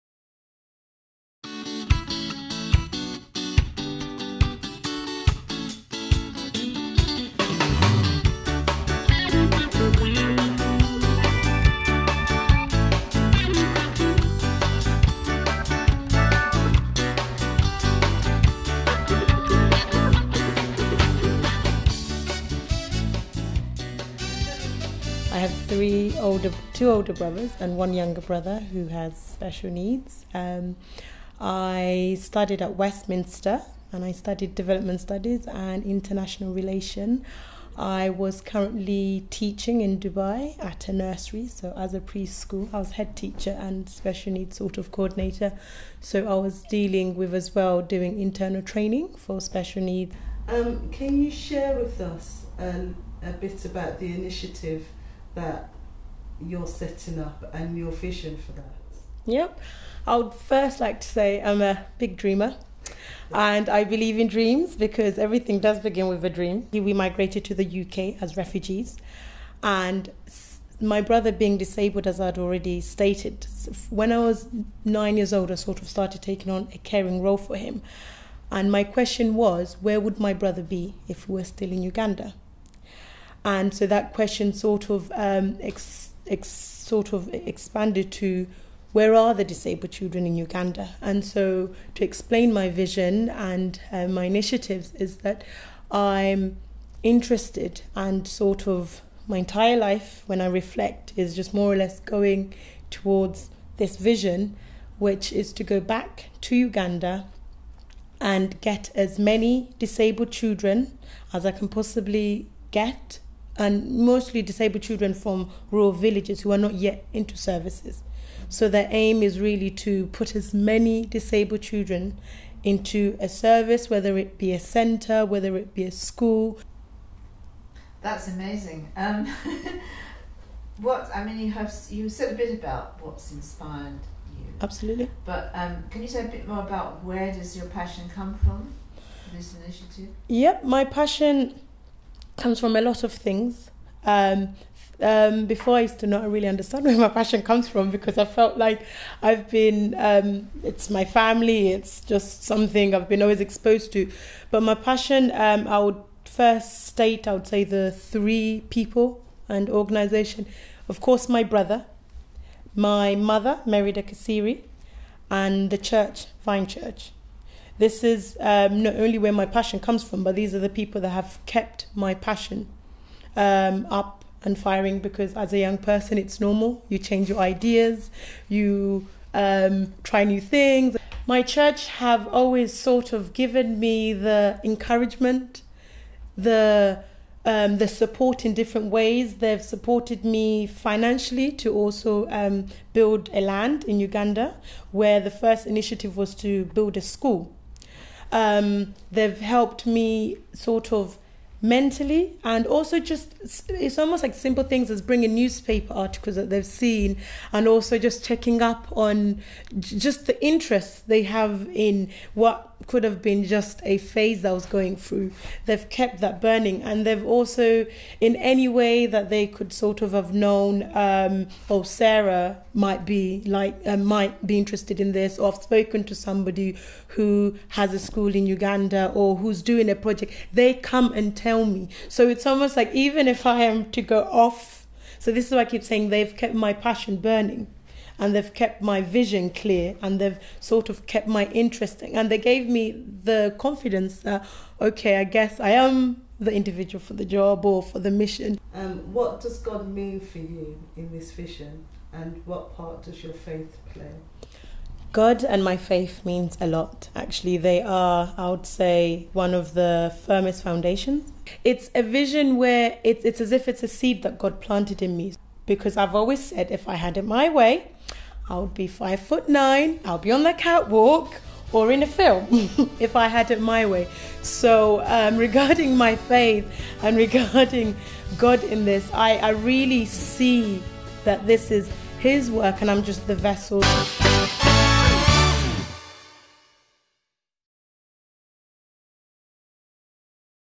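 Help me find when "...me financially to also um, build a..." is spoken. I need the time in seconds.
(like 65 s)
190 s.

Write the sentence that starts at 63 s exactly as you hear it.
And I believe in dreams because everything does begin with a dream.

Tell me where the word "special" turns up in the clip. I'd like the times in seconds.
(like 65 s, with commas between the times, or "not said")
29 s, 43 s, 49 s.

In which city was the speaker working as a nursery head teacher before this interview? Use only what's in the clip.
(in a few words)
Dubai.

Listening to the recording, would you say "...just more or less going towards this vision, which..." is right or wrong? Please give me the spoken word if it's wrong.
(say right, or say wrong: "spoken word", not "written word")
right.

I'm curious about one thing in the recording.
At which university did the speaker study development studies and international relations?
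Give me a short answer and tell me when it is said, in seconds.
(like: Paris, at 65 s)
Westminster, at 32 s.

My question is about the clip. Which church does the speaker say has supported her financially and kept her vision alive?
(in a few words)
Vine Church.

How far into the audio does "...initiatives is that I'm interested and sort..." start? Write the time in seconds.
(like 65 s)
94 s.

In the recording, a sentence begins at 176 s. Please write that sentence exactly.
You change your ideas, you um, try new things.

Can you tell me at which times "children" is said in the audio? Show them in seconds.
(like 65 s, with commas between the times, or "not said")
89 s, 110 s, 114 s, 121 s.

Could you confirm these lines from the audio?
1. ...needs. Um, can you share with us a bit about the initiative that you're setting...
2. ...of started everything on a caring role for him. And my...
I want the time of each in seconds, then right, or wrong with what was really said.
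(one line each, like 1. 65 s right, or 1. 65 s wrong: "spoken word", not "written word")
1. 49 s right
2. 75 s wrong: "taking", not "everything".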